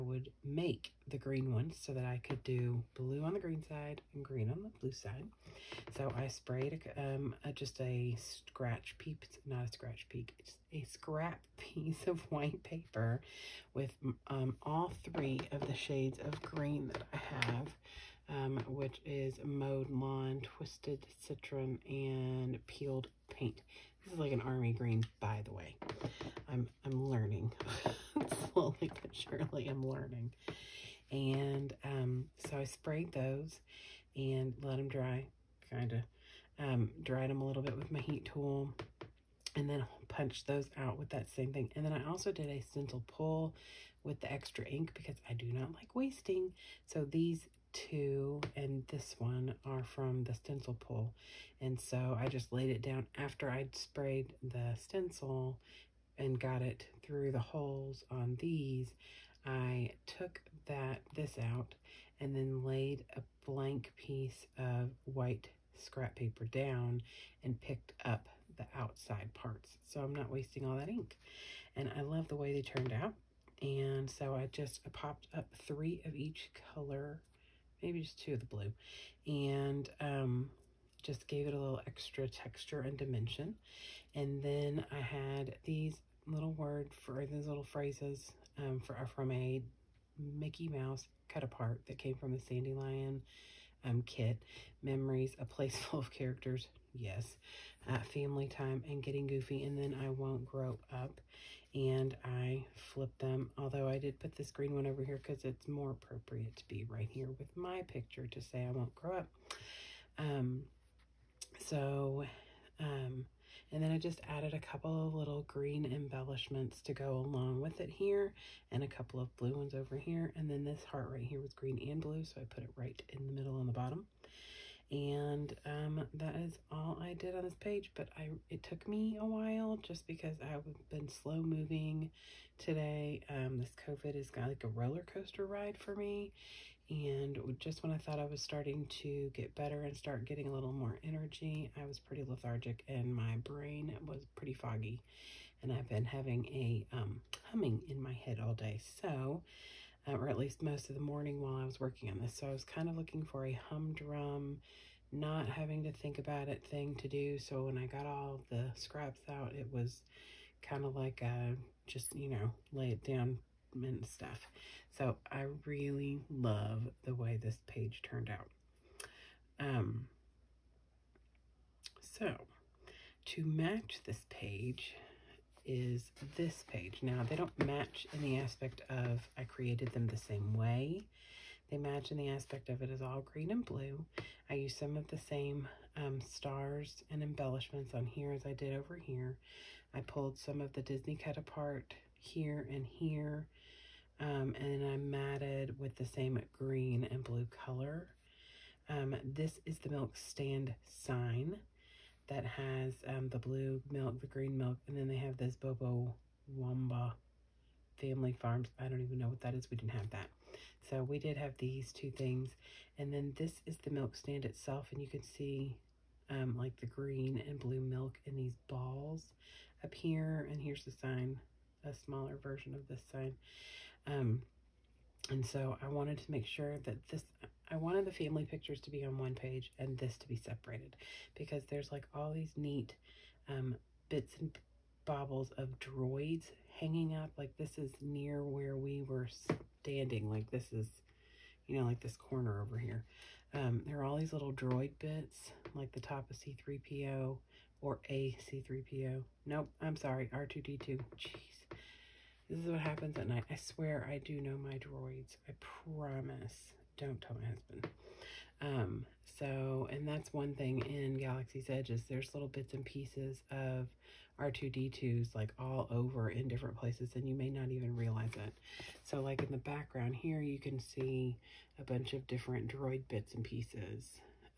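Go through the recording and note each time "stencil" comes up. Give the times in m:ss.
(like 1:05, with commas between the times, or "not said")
0:42, 0:50, 0:54.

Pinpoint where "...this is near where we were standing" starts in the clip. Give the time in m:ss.
3:57.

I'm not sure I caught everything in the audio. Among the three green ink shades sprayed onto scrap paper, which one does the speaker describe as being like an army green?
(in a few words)
Peeled Paint.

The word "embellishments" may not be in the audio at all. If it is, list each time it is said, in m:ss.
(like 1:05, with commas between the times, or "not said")
1:55, 3:07.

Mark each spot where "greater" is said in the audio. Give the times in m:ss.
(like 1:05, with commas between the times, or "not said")
not said.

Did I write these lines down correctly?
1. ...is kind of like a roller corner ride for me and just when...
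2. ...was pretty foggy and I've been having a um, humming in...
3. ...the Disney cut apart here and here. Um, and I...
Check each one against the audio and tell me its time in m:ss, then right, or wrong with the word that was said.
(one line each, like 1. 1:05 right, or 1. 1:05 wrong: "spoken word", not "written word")
1. 2:14 wrong: "coaster", not "corner"
2. 2:24 right
3. 3:10 right.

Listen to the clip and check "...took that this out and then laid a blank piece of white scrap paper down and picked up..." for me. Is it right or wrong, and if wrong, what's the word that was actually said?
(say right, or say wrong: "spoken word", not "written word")
right.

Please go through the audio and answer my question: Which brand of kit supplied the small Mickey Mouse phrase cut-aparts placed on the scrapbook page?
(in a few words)
Sandylion.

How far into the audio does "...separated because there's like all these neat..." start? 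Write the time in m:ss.
3:50.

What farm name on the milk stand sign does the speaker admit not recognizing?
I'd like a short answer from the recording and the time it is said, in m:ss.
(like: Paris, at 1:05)
Bubo Wamba Family Farms, at 3:25.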